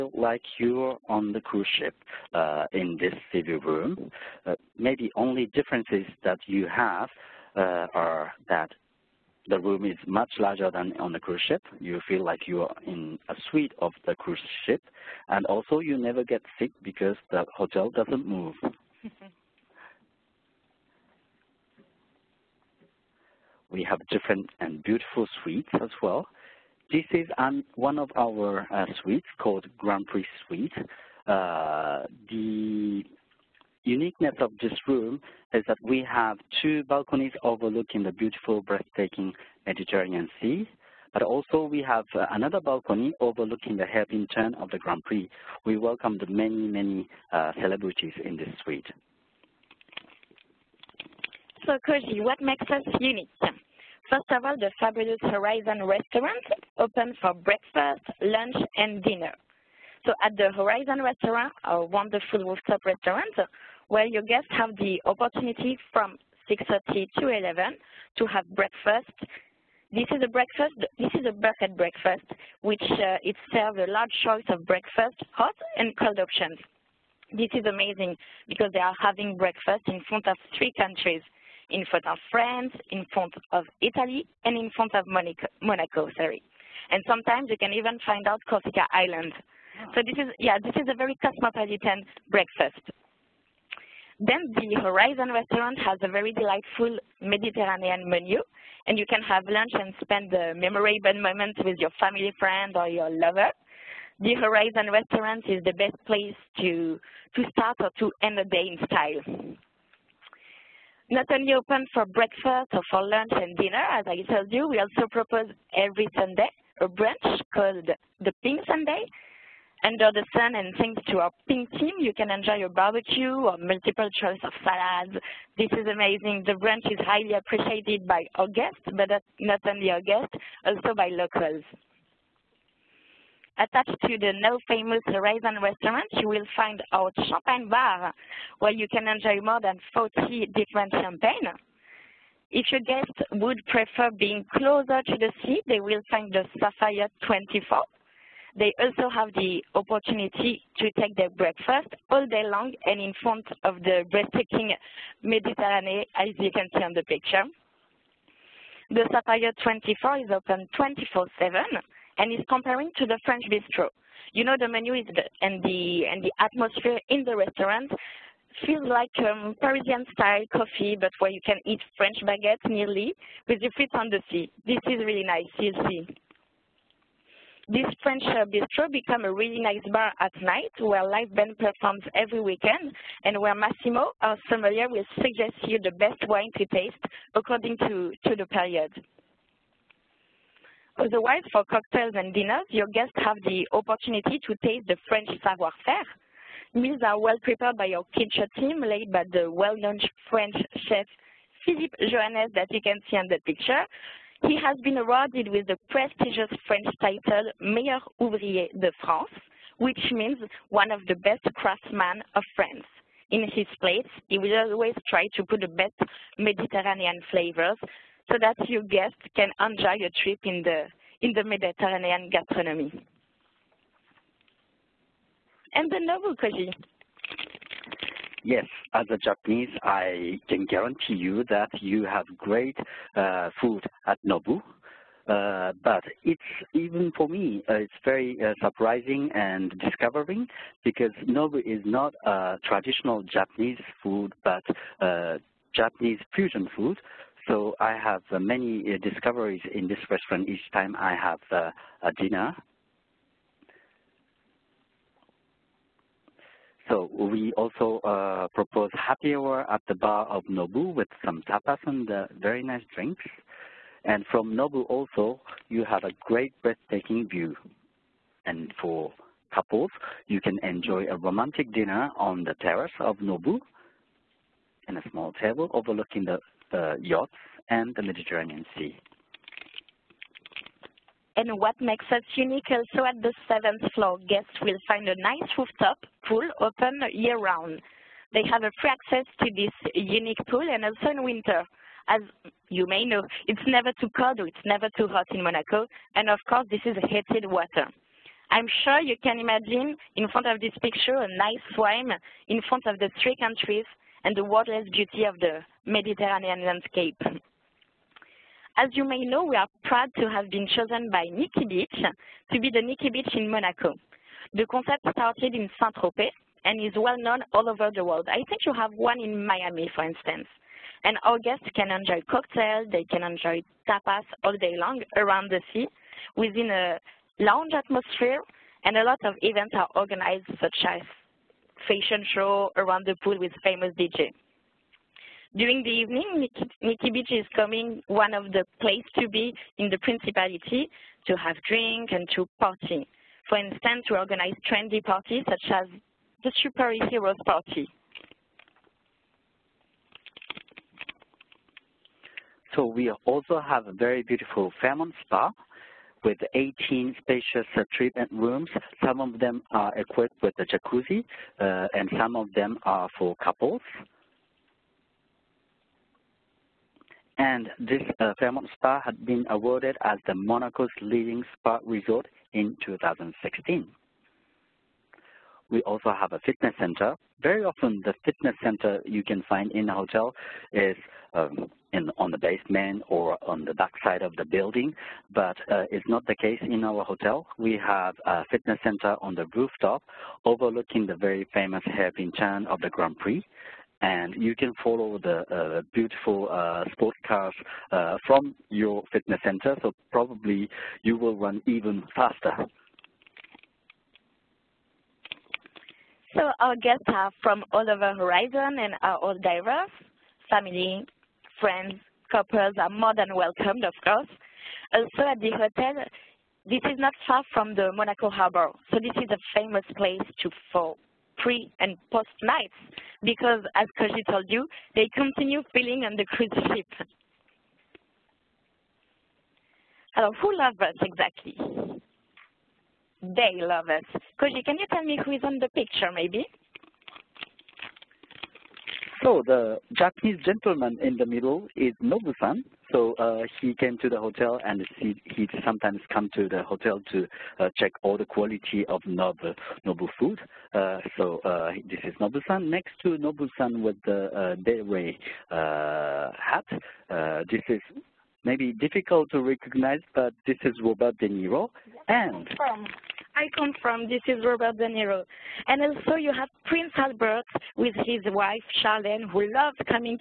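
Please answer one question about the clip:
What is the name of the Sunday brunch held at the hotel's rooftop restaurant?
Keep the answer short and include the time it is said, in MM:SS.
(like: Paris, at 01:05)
Pink Sunday, at 01:58.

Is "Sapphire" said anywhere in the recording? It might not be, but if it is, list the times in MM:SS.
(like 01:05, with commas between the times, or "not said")
02:26, 02:39.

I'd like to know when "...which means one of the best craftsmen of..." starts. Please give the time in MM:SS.
03:29.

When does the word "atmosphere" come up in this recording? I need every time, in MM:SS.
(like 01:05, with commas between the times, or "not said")
02:46, 05:27.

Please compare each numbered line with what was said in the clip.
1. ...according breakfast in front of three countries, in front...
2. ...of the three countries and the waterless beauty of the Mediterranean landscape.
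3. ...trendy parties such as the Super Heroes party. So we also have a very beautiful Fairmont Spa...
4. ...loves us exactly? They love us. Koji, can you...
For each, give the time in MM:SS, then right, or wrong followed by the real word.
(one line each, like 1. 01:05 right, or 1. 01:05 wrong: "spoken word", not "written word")
1. 01:19 wrong: "having", not "according"
2. 05:02 right
3. 05:44 right
4. 07:10 right.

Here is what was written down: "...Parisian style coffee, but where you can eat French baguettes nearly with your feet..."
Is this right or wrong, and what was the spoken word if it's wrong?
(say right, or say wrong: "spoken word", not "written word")
right.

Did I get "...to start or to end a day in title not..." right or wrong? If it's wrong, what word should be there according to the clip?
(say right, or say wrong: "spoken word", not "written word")
wrong: "style", not "title".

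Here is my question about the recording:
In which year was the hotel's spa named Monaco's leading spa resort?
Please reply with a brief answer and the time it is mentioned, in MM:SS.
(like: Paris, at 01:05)
2016, at 06:12.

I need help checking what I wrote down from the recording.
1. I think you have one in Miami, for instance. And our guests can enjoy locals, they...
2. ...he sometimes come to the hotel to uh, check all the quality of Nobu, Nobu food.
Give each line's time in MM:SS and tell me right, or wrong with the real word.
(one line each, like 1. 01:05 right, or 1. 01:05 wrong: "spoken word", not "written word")
1. 05:18 wrong: "cocktails", not "locals"
2. 07:25 right.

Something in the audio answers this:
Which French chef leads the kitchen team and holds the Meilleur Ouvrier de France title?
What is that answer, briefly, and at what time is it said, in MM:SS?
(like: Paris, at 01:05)
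Philippe Joannès, at 03:21.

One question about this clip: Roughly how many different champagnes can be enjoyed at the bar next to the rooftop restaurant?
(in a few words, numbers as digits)
more than 40.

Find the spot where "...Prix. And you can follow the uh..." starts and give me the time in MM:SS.
06:33.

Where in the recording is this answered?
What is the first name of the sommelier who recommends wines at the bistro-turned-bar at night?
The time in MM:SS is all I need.
03:03.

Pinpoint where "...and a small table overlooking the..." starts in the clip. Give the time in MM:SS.
04:34.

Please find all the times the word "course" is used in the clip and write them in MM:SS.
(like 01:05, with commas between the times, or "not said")
04:56, 06:54.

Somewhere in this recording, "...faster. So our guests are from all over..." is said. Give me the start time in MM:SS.
06:42.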